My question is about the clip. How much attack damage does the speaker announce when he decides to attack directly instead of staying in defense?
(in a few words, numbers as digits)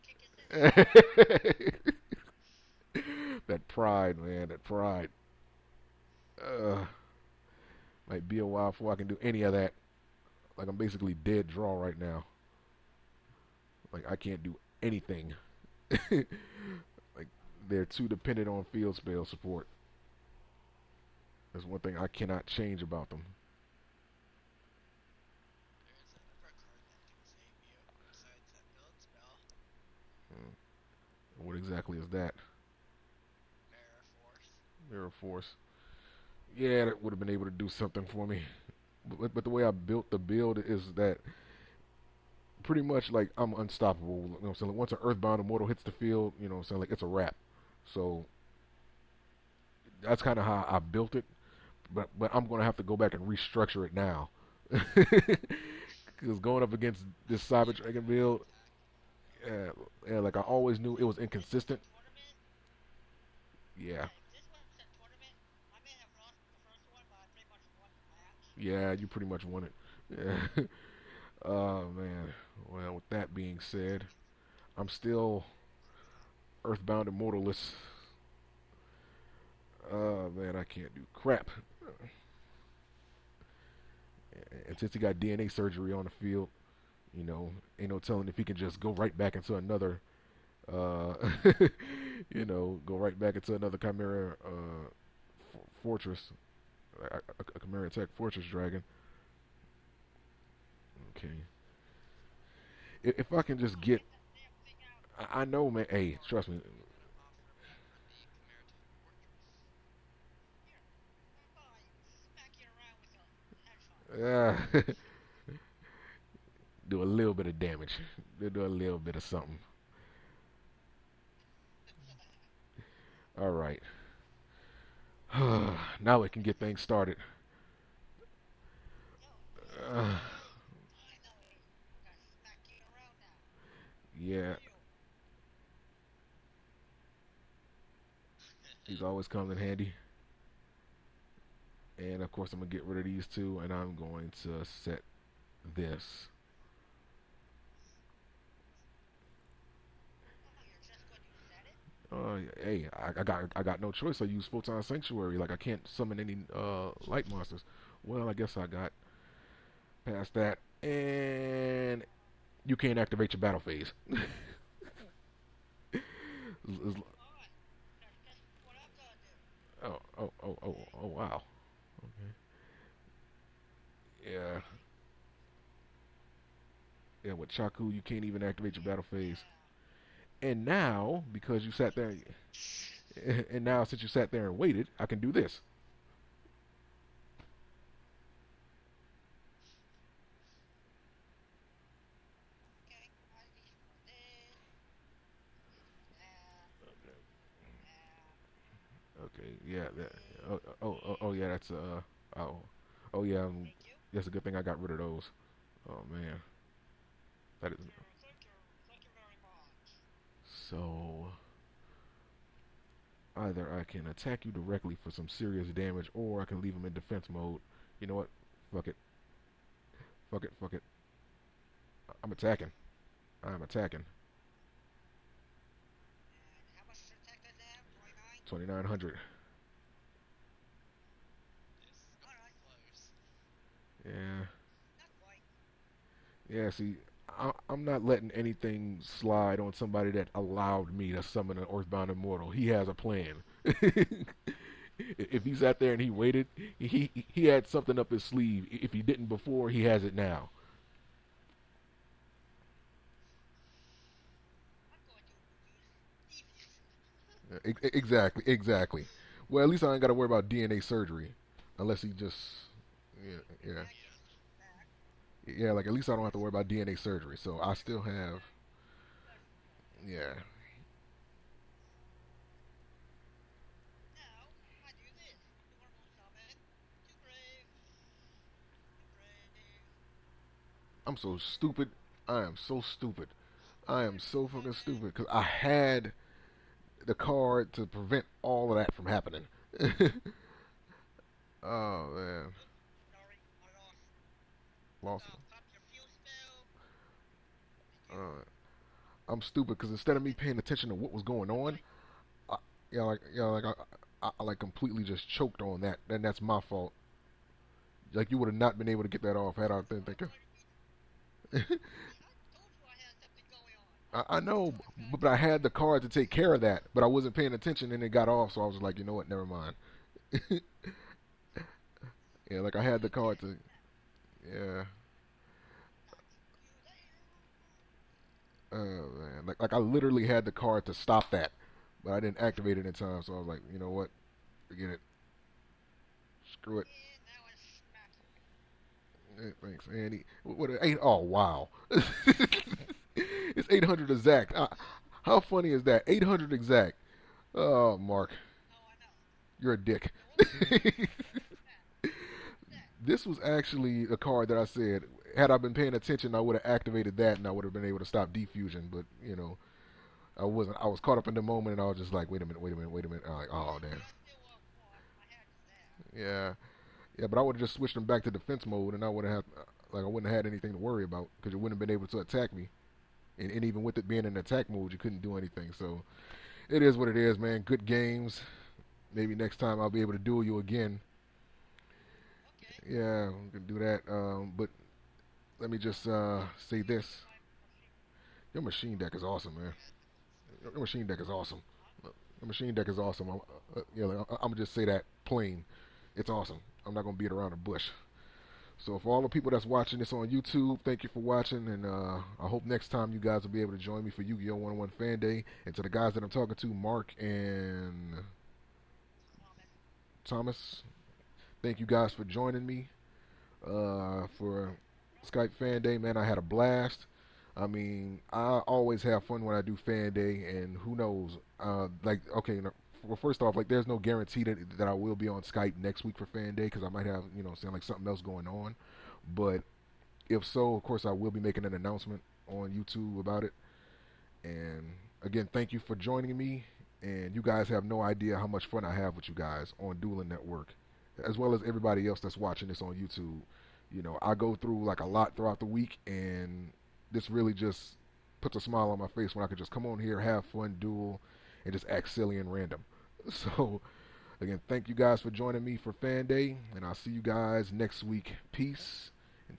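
2900.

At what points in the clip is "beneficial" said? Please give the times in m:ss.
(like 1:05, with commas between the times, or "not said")
not said.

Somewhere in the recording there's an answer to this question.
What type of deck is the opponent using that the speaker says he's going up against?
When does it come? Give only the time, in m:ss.
0:57.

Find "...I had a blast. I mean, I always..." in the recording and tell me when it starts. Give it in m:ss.
6:56.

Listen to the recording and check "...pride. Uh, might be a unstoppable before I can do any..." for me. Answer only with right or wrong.
wrong.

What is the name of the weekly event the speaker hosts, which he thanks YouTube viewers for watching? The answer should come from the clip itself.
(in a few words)
Yu-Gi-Oh! 101 Fan Day.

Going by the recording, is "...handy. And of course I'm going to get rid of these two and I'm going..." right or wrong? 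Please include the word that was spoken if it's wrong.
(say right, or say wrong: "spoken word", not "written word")
right.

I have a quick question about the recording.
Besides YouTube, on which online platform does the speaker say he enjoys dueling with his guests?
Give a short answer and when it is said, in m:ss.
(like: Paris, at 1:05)
Dueling Network, at 7:20.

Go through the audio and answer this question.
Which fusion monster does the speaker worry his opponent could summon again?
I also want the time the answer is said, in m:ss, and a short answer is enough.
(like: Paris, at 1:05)
Chimeratech Fortress Dragon, at 1:37.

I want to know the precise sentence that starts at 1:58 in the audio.
They'll do a little bit of something.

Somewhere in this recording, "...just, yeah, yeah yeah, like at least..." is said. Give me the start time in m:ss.
4:22.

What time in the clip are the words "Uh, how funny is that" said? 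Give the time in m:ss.
5:44.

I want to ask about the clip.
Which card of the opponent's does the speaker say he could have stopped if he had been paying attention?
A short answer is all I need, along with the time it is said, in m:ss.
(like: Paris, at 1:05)
De-Fusion, at 5:58.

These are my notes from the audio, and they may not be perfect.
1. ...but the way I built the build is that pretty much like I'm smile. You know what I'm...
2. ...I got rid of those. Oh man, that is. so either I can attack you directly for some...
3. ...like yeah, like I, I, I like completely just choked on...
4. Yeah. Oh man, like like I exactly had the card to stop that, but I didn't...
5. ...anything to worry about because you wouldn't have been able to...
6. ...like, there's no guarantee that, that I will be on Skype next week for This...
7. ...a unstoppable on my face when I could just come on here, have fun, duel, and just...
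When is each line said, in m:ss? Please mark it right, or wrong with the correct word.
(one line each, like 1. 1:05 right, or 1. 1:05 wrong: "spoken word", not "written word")
1. 0:39 wrong: "unstoppable", not "smile"
2. 3:24 right
3. 5:03 right
4. 5:24 wrong: "literally", not "exactly"
5. 6:10 right
6. 7:03 wrong: "Fan", not "This"
7. 7:28 wrong: "smile", not "unstoppable".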